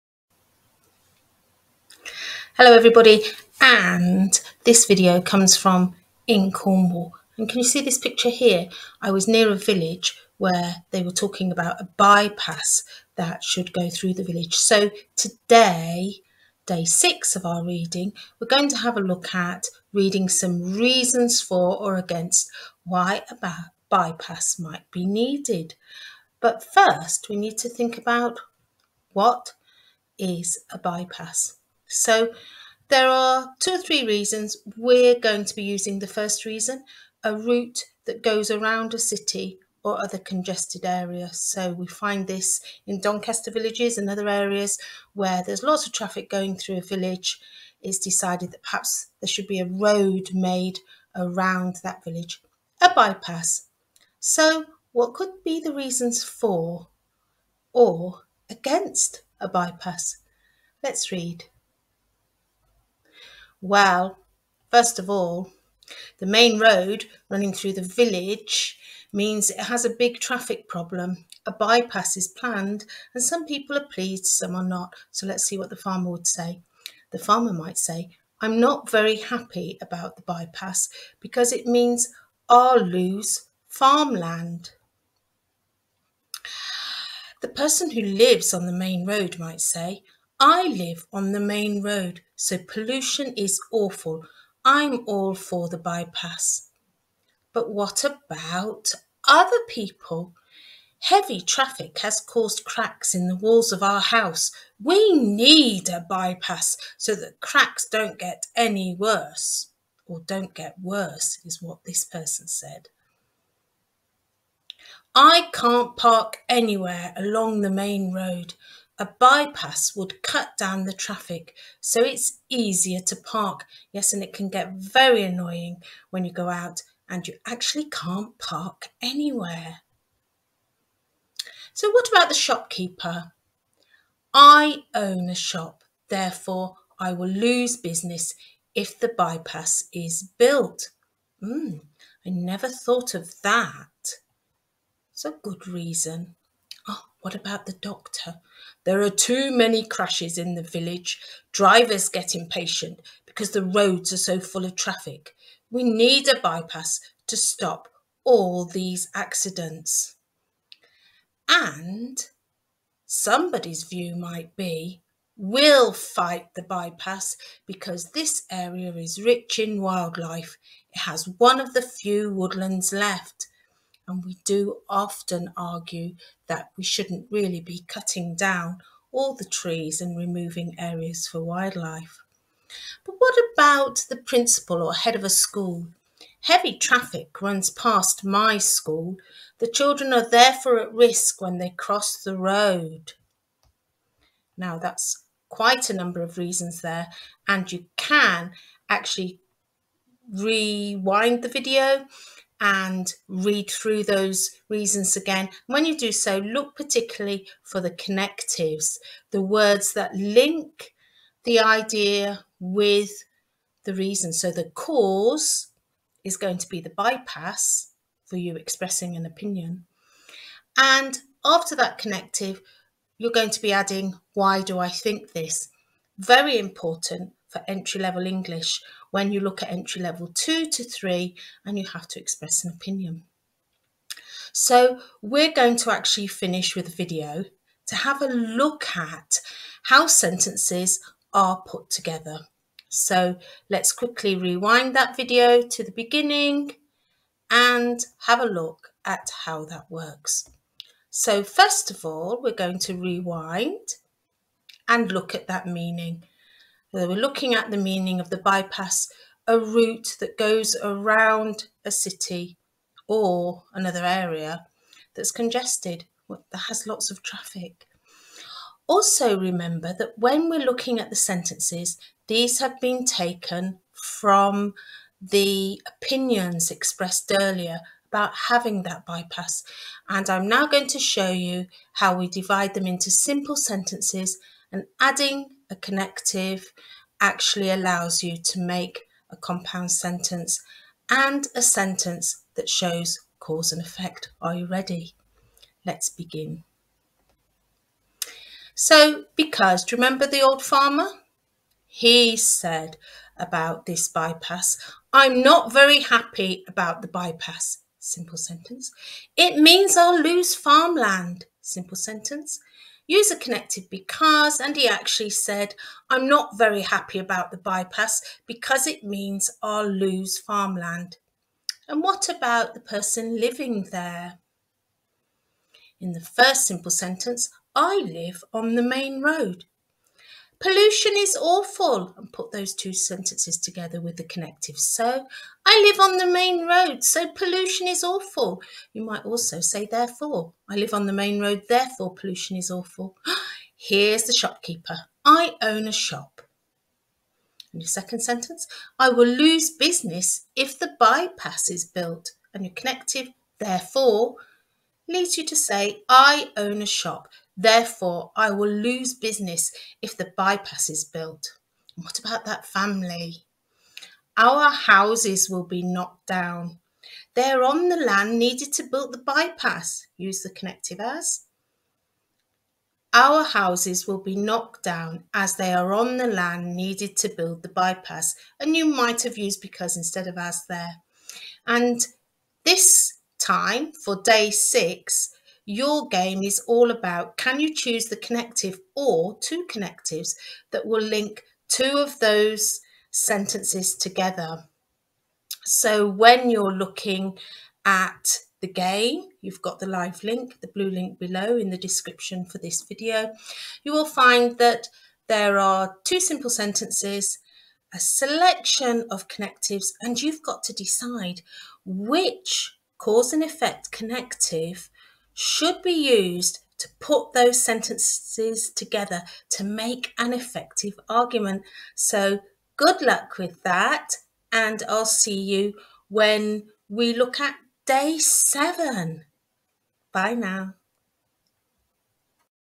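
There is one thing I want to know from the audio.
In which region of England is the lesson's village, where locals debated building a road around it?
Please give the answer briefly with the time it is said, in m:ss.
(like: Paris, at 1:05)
Cornwall, at 0:06.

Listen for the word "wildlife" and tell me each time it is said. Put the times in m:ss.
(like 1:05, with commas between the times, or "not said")
2:49, 3:01.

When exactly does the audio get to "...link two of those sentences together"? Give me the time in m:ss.
6:31.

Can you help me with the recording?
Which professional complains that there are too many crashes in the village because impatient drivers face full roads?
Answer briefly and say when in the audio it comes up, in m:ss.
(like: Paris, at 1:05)
The doctor, at 2:27.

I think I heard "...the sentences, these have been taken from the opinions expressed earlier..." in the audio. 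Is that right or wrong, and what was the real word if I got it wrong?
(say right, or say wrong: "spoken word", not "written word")
right.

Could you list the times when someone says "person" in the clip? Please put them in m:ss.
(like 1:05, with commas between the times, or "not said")
1:27, 1:52, 5:22.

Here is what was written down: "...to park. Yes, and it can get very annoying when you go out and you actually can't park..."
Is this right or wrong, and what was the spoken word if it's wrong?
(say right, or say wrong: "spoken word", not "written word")
right.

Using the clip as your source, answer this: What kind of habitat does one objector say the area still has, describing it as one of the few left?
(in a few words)
Woodlands.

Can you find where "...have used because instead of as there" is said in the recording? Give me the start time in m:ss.
6:19.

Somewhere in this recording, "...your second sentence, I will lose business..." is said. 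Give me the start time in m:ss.
5:47.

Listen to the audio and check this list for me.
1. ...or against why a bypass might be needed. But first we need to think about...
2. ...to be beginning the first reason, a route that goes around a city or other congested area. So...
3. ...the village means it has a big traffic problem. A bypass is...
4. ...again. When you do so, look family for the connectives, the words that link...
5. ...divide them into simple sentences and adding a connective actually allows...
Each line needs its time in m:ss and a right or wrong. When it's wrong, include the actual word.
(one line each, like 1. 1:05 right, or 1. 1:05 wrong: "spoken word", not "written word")
1. 0:21 right
2. 0:35 wrong: "using", not "beginning"
3. 1:07 right
4. 3:25 wrong: "particularly", not "family"
5. 4:42 right.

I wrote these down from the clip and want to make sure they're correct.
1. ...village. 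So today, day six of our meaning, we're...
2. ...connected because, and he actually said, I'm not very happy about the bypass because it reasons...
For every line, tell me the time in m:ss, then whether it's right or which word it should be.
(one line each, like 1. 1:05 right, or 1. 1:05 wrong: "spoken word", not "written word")
1. 0:14 wrong: "reading", not "meaning"
2. 5:13 wrong: "means", not "reasons".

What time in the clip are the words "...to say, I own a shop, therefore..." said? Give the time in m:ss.
5:55.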